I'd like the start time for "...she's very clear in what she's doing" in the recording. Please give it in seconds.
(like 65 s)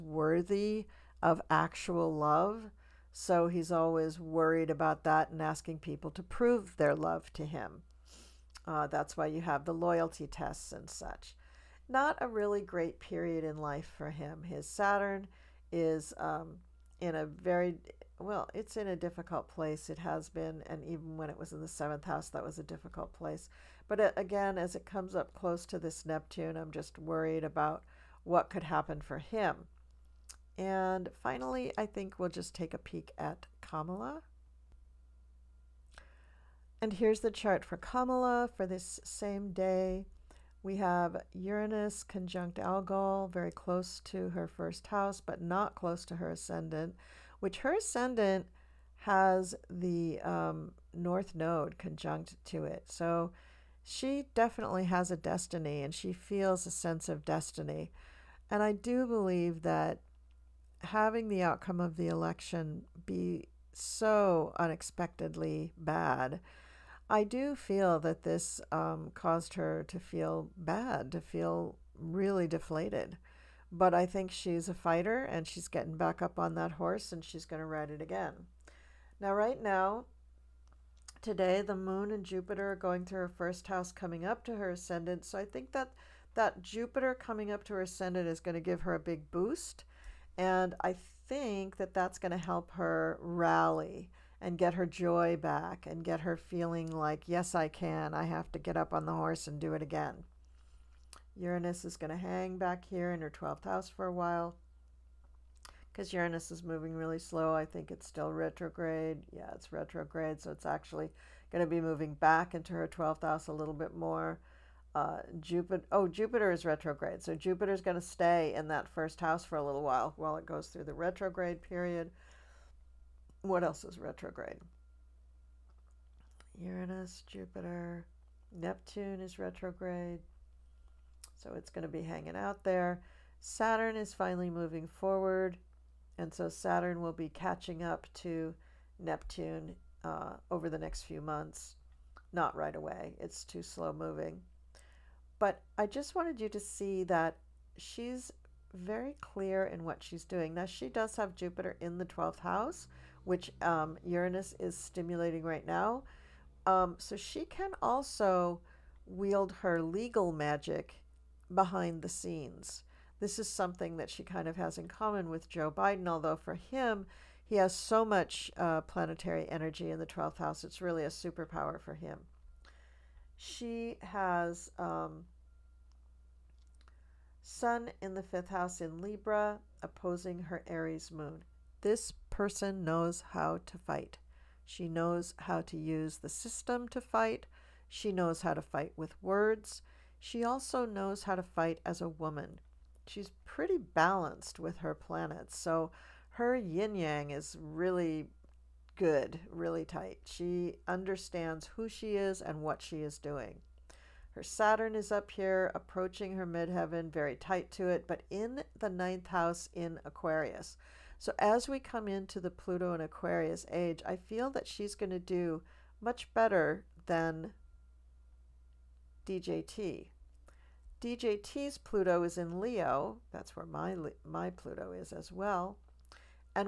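147 s.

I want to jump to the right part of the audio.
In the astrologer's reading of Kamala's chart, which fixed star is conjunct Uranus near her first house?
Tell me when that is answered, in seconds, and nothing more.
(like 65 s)
42 s.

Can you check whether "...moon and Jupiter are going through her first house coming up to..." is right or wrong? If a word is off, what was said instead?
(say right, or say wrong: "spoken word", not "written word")
right.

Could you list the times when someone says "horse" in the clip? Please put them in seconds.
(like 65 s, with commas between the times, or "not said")
76 s, 99 s.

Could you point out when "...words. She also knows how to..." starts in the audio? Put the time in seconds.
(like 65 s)
189 s.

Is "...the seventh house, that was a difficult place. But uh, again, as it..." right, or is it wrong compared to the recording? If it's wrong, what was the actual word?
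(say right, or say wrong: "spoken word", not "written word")
right.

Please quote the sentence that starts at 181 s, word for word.
This person knows how to fight.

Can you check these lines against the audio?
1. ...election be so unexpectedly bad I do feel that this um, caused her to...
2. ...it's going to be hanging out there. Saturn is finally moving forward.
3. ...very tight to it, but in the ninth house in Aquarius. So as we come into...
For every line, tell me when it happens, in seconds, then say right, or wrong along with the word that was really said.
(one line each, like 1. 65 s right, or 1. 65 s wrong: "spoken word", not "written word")
1. 62 s right
2. 131 s right
3. 207 s right.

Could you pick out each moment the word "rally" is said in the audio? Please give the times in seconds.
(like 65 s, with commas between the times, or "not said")
93 s.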